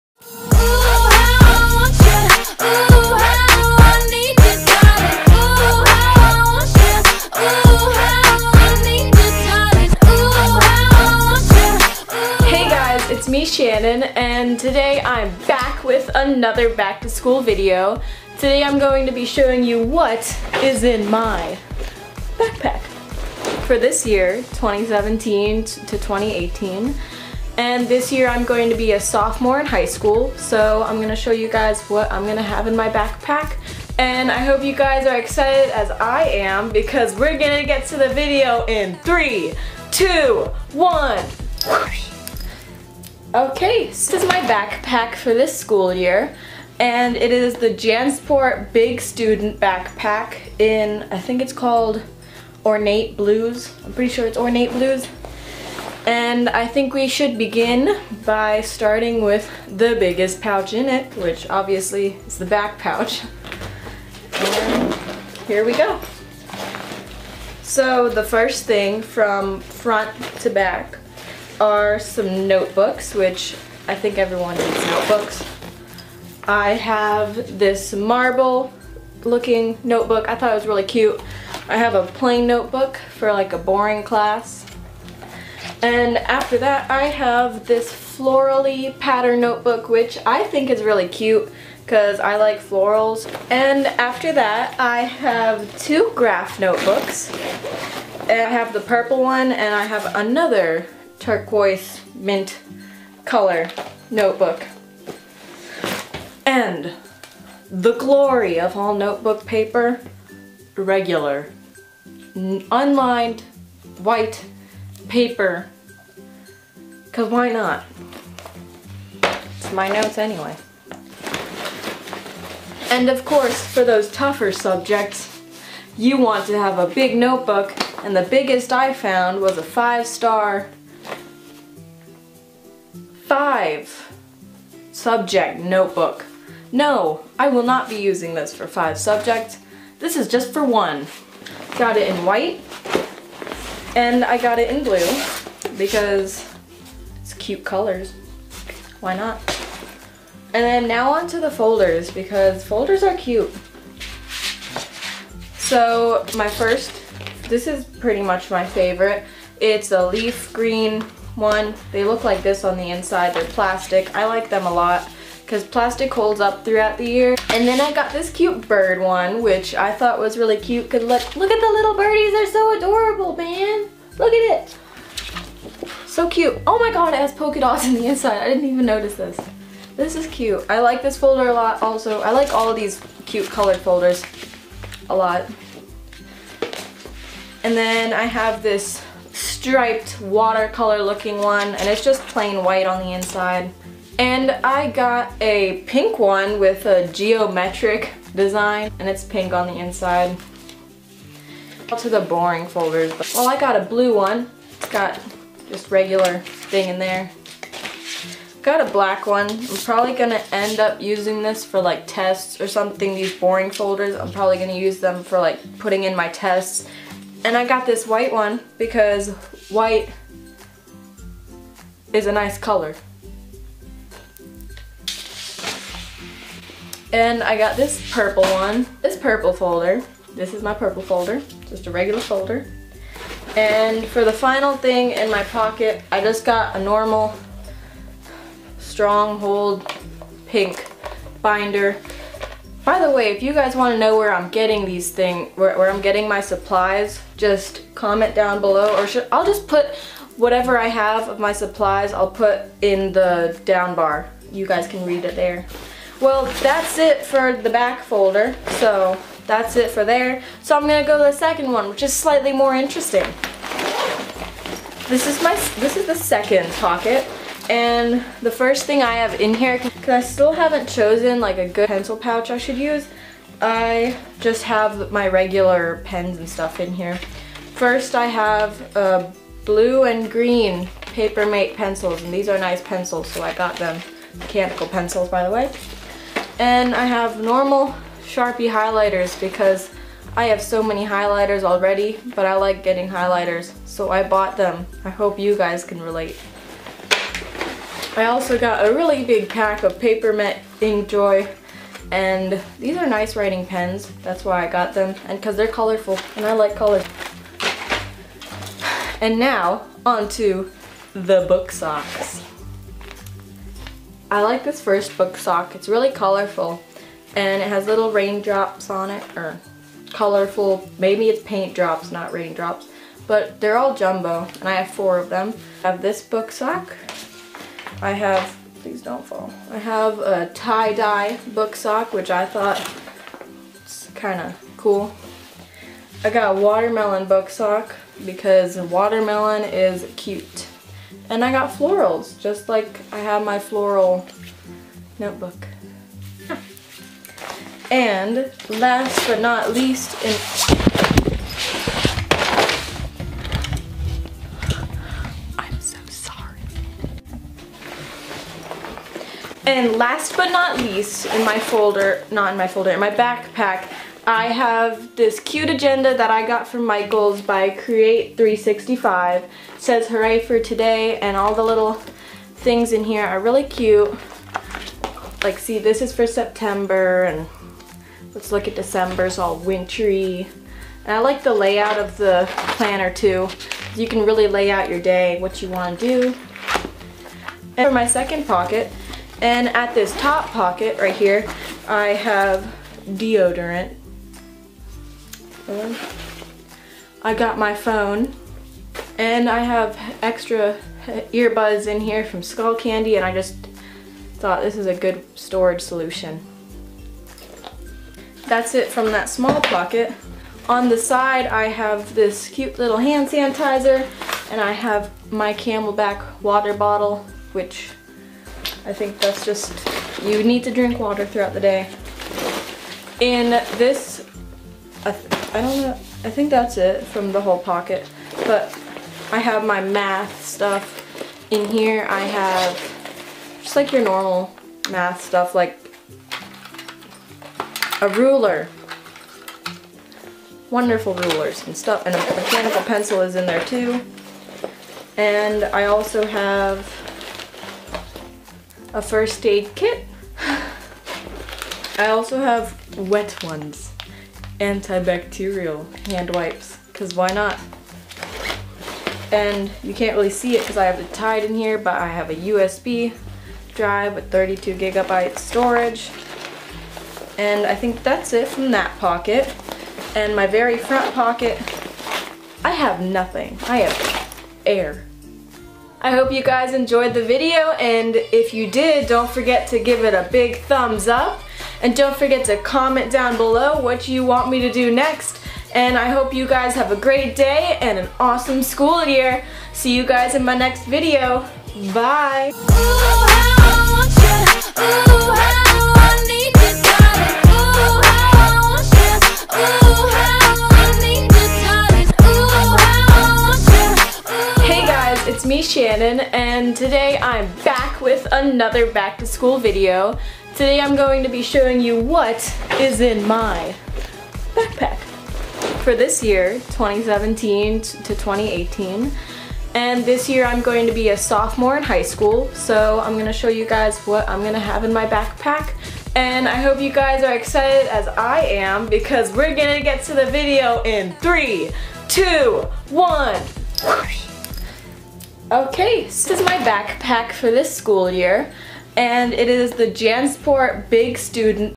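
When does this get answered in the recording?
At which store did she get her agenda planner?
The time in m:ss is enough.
6:06.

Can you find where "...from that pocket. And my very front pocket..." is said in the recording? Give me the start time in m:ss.
7:48.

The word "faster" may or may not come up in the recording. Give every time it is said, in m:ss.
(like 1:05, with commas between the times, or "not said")
not said.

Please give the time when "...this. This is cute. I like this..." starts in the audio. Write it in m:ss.
2:59.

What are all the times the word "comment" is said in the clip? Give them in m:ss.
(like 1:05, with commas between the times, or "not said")
4:07, 8:02.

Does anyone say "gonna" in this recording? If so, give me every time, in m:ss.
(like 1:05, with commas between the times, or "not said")
3:30, 3:34, 4:20.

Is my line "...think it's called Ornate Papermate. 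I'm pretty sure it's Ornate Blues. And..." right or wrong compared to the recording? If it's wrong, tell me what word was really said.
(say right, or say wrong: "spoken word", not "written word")
wrong: "Blues", not "Papermate".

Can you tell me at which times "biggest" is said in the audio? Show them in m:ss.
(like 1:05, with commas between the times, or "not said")
0:59, 2:08.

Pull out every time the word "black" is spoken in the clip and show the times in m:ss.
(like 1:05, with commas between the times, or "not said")
3:28.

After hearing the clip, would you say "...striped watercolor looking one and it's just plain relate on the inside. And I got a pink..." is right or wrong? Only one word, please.
wrong.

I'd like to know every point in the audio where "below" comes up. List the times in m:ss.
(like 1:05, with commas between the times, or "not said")
4:08, 8:03.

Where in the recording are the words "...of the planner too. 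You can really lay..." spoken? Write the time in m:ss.
6:21.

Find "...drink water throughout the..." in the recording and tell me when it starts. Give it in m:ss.
7:00.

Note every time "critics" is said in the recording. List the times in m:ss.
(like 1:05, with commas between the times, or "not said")
not said.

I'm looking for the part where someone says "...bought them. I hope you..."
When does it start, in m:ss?
4:54.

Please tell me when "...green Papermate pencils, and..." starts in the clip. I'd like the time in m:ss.
4:40.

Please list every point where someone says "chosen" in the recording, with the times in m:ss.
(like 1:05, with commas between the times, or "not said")
4:30.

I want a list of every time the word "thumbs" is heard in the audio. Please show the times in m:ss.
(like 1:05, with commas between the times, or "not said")
8:00.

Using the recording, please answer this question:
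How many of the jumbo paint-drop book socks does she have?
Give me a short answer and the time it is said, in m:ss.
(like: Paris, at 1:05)
4, at 5:24.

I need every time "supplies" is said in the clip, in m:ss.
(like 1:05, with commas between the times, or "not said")
4:06, 4:11.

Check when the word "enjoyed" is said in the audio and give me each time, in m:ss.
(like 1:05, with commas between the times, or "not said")
7:56.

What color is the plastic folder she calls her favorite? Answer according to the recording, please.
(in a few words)
leaf green.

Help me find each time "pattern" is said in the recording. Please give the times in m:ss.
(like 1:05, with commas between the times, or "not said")
1:28.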